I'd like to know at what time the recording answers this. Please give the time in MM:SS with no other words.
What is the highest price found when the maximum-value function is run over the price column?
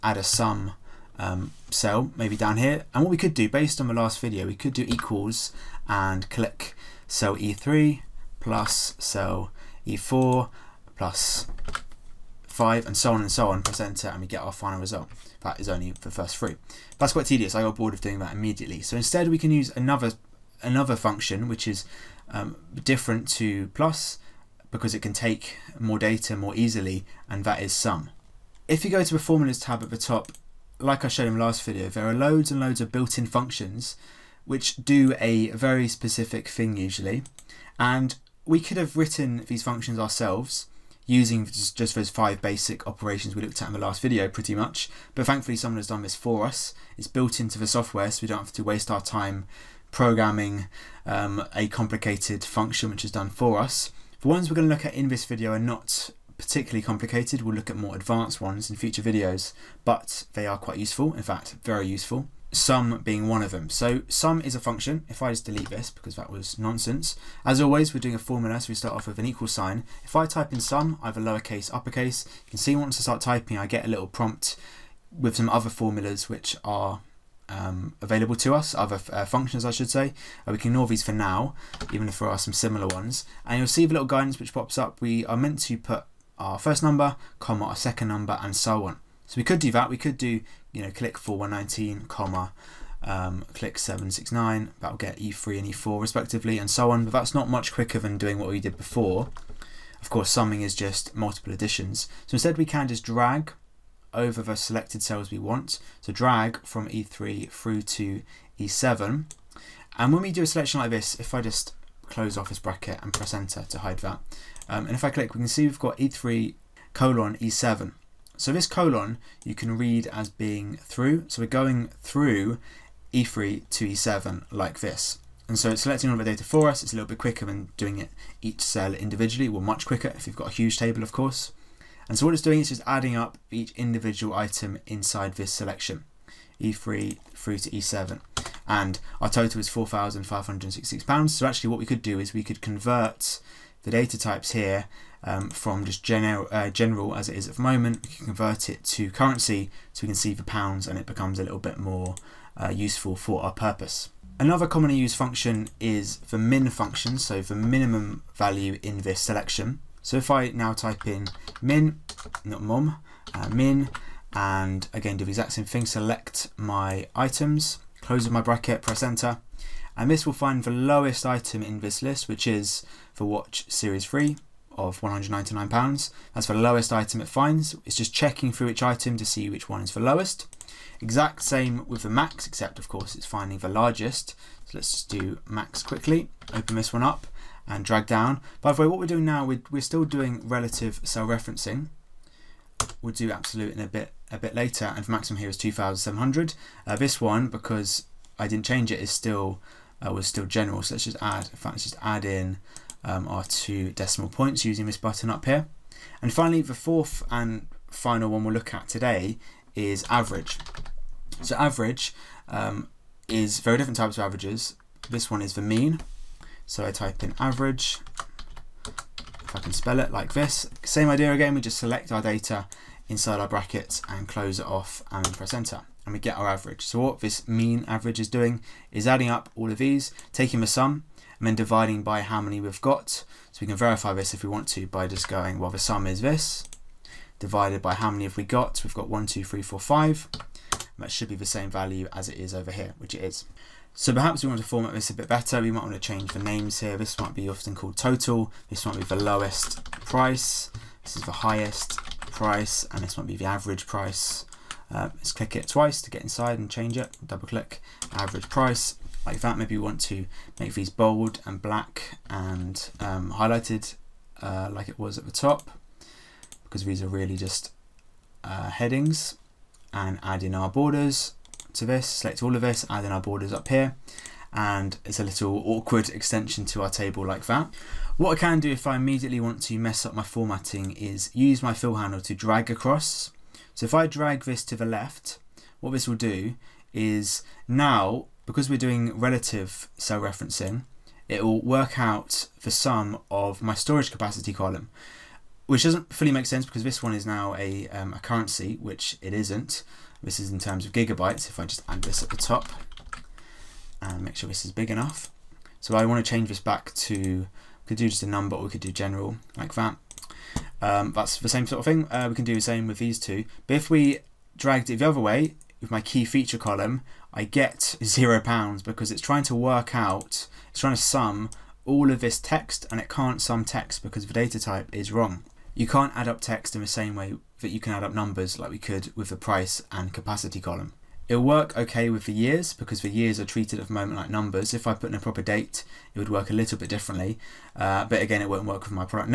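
03:15.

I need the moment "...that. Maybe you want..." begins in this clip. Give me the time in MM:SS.
04:19.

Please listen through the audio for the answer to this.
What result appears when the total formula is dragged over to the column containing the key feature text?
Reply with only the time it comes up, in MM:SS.
05:18.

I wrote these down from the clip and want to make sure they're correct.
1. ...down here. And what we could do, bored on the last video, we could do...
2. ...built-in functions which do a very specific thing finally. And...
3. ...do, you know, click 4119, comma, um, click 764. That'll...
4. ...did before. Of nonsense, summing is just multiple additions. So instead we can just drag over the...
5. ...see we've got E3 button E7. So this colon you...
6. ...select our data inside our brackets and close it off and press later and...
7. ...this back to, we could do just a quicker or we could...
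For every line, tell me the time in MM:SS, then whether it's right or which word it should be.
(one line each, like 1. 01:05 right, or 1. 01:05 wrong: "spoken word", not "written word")
1. 00:02 wrong: "based", not "bored"
2. 00:32 wrong: "usually", not "finally"
3. 01:30 wrong: "769", not "764"
4. 01:38 wrong: "course", not "nonsense"
5. 01:55 wrong: "colon", not "button"
6. 03:41 wrong: "enter", not "later"
7. 05:06 wrong: "number", not "quicker".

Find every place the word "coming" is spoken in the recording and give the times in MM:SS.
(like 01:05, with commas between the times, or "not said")
not said.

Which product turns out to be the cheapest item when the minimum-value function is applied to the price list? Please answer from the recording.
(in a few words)
Watch Series 3.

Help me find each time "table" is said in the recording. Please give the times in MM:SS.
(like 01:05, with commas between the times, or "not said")
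02:10, 04:36.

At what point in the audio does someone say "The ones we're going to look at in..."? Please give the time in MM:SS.
00:54.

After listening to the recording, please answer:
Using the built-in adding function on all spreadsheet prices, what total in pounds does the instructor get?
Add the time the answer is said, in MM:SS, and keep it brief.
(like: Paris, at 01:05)
£4,566, at 02:19.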